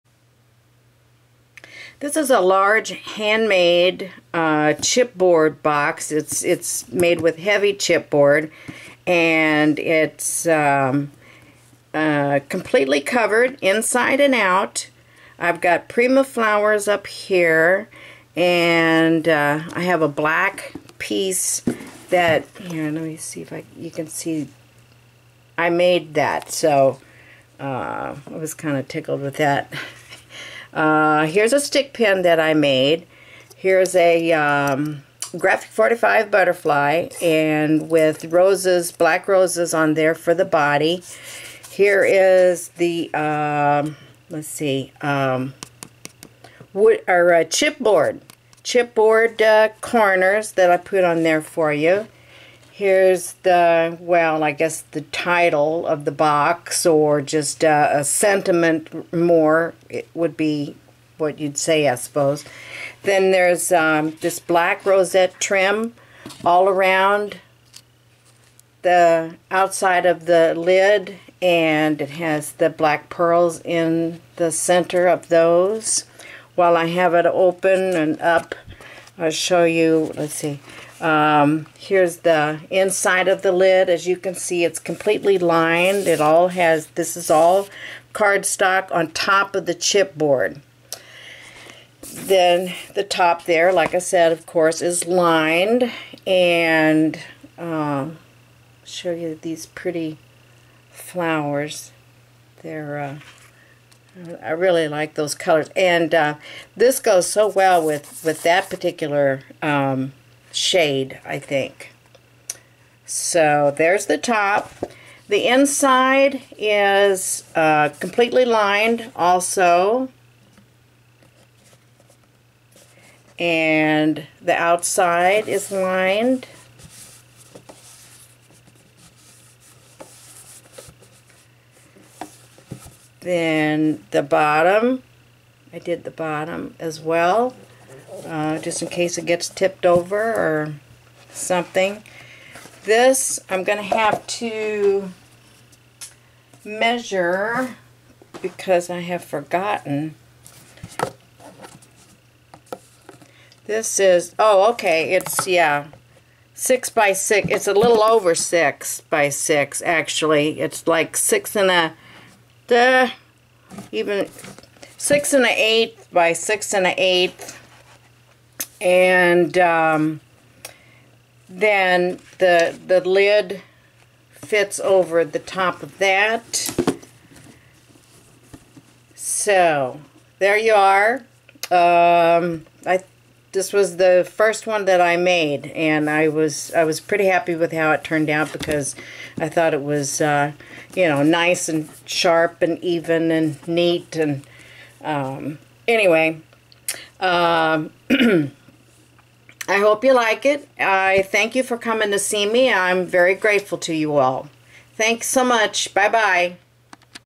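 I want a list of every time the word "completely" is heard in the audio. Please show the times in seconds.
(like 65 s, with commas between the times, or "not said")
12 s, 84 s, 117 s.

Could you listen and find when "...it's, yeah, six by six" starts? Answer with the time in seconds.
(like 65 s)
155 s.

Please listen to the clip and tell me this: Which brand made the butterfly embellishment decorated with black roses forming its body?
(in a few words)
Graphic 45.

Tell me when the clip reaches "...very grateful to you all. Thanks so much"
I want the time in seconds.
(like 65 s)
203 s.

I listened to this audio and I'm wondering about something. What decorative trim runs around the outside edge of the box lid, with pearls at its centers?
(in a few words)
black rosette trim.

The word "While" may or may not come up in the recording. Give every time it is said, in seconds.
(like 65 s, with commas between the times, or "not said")
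76 s.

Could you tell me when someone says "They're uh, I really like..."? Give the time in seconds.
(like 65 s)
102 s.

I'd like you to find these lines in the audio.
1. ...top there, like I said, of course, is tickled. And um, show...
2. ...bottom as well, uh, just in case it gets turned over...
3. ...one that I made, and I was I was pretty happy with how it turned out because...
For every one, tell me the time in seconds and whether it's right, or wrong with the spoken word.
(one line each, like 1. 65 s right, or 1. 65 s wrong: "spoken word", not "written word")
1. 93 s wrong: "lined", not "tickled"
2. 136 s wrong: "tipped", not "turned"
3. 184 s right.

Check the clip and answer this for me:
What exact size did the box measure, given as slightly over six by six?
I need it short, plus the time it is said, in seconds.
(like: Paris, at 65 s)
6 1/8 by 6 1/8, at 164 s.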